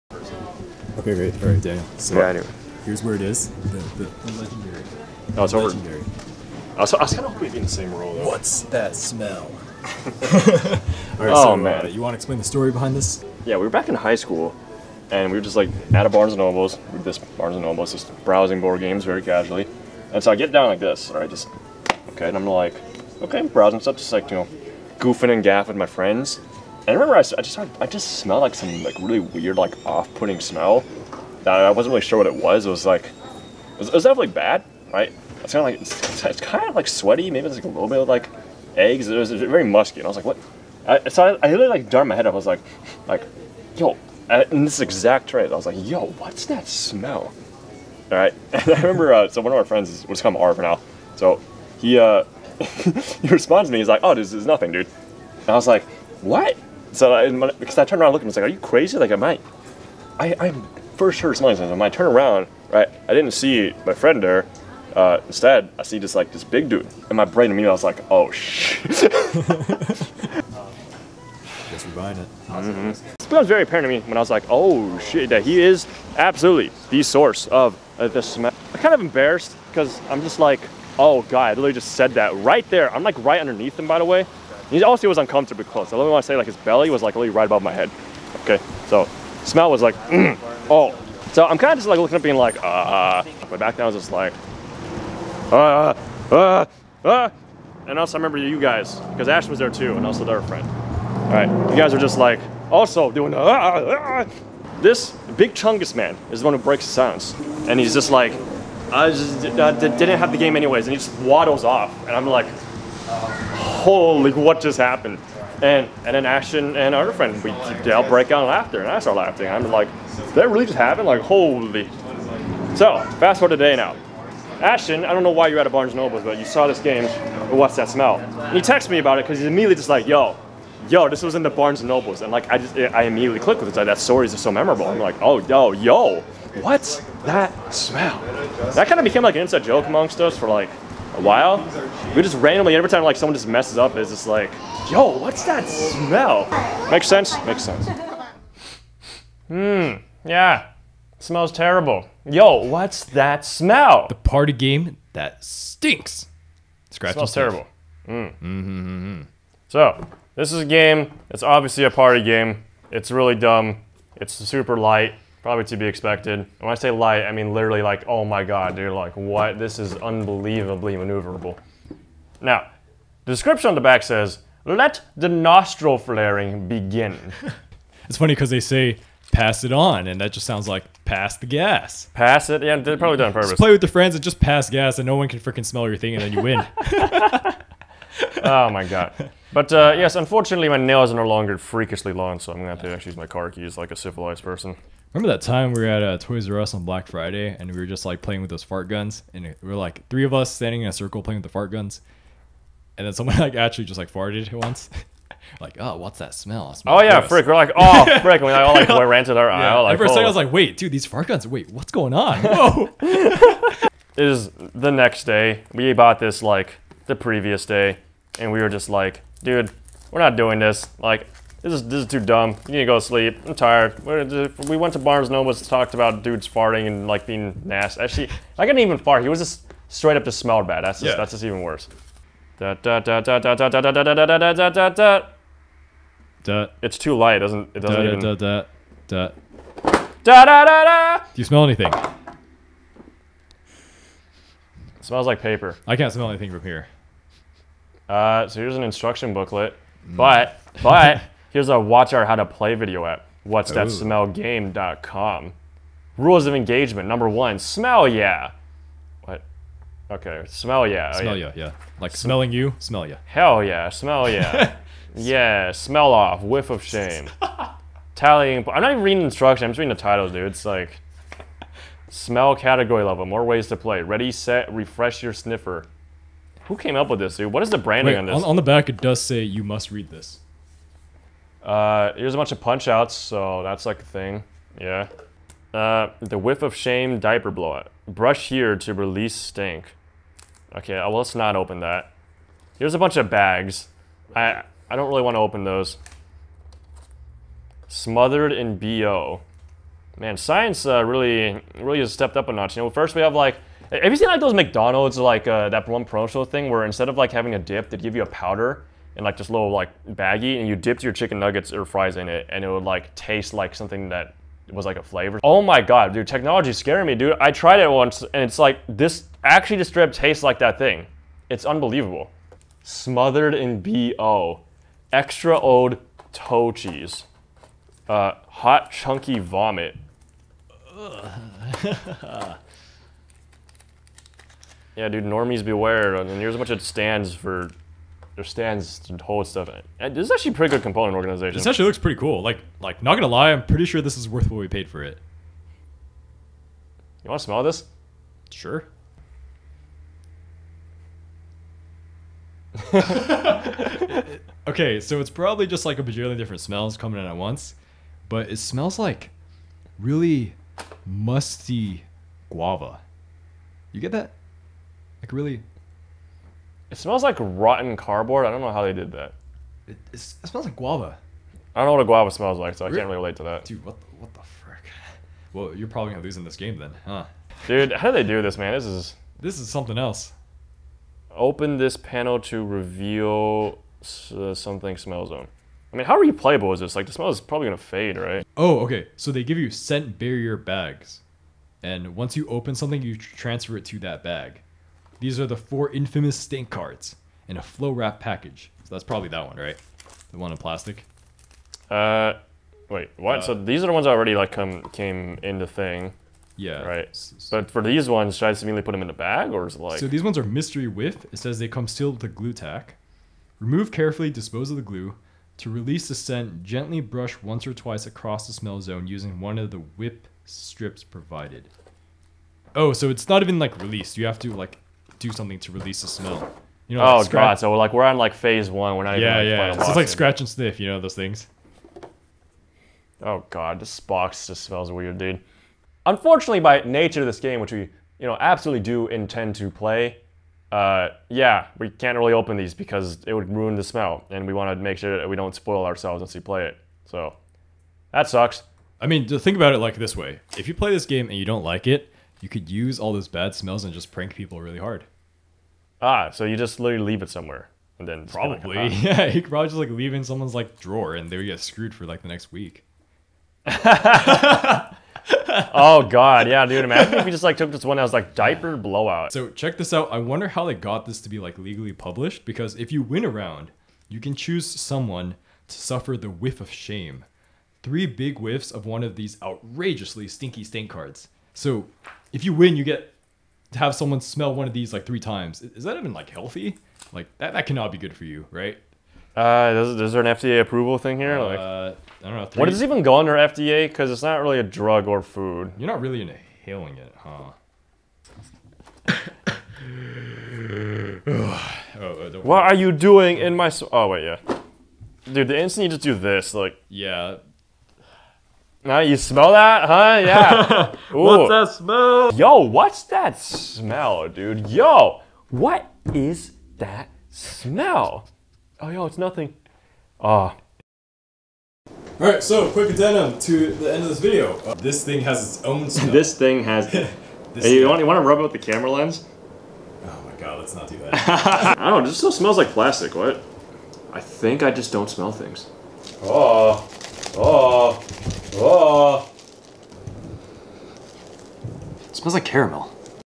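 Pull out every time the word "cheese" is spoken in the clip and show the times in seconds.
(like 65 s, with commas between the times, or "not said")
326 s.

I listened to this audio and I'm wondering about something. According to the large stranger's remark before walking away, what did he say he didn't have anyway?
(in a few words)
the game.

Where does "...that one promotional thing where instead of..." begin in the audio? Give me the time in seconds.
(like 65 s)
305 s.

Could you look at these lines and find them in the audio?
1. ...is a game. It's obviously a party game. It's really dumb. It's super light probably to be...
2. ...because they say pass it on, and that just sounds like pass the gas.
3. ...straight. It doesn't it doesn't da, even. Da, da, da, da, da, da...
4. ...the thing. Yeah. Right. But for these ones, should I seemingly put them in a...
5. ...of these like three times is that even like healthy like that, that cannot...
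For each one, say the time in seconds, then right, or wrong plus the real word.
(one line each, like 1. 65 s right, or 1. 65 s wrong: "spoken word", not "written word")
1. 160 s right
2. 178 s right
3. 237 s wrong: "light", not "straight"
4. 405 s right
5. 484 s right.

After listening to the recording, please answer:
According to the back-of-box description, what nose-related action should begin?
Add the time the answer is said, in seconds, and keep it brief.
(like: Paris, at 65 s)
nostril flaring, at 175 s.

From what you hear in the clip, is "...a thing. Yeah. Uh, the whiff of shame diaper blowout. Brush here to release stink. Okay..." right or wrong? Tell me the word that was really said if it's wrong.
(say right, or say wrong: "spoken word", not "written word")
right.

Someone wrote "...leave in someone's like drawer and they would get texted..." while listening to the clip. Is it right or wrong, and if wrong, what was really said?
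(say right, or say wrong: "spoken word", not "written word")
wrong: "screwed", not "texted".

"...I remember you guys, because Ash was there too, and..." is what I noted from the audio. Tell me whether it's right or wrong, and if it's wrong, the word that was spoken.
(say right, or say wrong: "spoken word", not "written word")
right.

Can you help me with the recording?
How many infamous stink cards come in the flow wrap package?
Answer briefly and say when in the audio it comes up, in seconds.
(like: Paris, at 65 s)
4, at 395 s.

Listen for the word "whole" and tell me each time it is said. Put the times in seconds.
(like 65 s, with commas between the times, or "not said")
339 s.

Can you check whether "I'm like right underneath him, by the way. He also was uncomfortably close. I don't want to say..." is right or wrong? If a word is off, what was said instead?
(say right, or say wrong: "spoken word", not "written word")
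right.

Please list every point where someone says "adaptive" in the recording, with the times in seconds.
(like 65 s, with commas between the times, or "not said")
not said.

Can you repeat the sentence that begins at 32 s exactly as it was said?
It was like it was, it was definitely bad, right?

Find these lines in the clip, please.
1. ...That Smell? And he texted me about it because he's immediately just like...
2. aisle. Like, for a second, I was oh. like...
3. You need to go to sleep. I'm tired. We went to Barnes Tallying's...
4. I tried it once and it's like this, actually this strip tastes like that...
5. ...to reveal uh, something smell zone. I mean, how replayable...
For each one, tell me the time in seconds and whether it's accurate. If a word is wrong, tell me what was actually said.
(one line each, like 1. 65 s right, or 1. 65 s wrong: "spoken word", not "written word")
1. 127 s right
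2. 209 s right
3. 222 s wrong: "Noble", not "Tallying"
4. 317 s right
5. 382 s right.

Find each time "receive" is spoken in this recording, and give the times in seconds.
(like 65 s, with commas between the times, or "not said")
not said.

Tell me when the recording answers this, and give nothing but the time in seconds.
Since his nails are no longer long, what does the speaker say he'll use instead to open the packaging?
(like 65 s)
193 s.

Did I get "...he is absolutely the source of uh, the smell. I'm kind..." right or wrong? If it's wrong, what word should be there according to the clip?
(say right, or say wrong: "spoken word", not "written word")
right.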